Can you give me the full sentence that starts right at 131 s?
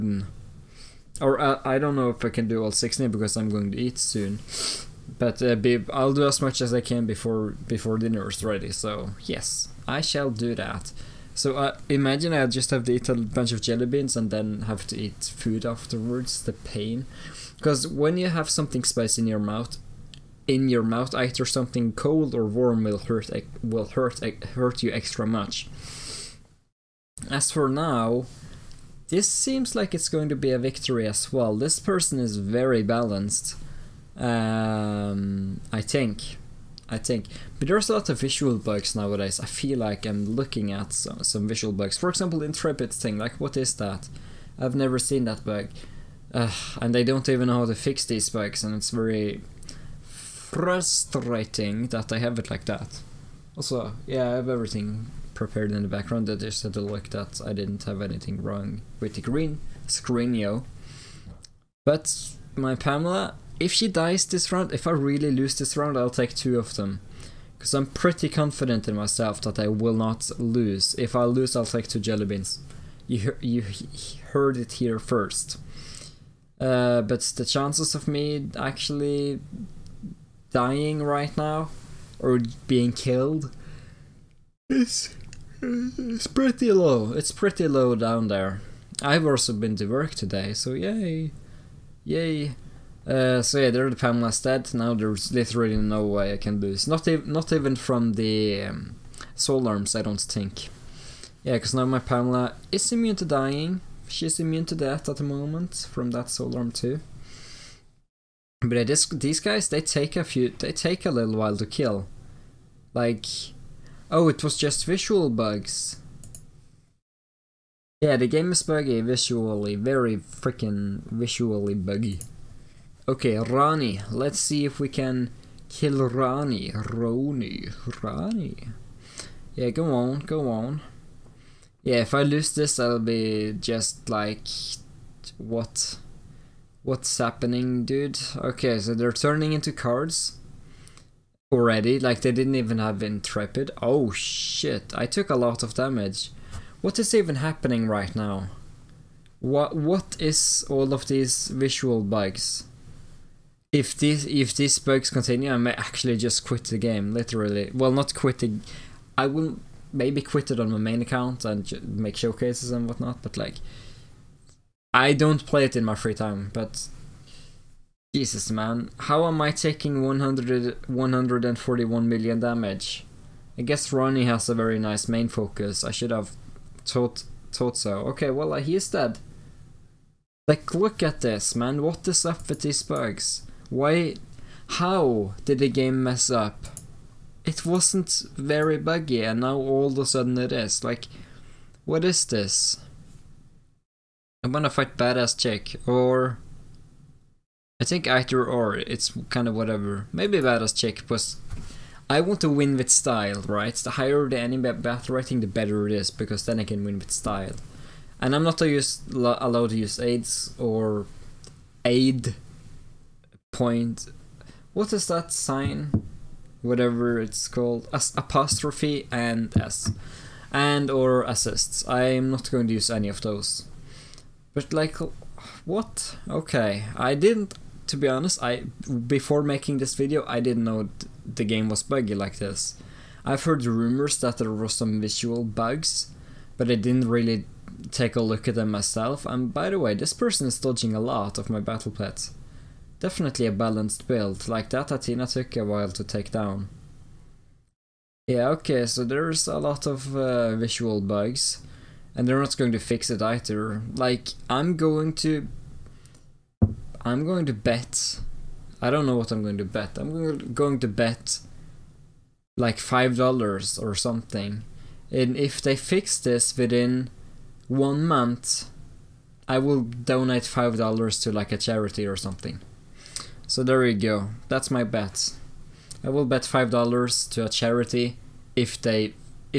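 Yeah, if I lose this, I'll be just like, what?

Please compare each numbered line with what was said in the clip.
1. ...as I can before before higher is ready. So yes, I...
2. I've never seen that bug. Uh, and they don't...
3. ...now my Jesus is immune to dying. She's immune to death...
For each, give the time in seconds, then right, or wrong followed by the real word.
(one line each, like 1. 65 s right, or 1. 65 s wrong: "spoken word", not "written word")
1. 6 s wrong: "dinner", not "higher"
2. 44 s right
3. 101 s wrong: "Pamela", not "Jesus".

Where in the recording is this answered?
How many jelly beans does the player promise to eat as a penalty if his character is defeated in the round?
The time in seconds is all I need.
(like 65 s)
66 s.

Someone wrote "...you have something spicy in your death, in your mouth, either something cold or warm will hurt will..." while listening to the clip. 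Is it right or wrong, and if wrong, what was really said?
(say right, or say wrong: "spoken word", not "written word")
wrong: "mouth", not "death".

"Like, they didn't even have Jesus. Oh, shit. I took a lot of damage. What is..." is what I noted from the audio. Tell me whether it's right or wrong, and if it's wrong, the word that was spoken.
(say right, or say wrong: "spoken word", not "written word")
wrong: "Intrepid", not "Jesus".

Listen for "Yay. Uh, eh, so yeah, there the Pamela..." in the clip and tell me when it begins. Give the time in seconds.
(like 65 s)
92 s.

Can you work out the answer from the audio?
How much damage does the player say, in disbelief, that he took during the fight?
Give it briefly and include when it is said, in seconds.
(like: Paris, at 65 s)
141 million, at 170 s.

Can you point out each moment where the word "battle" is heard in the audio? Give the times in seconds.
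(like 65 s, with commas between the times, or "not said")
204 s, 241 s.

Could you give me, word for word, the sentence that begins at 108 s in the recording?
But yeah, this, these guys, they take a few, they take a little while to kill.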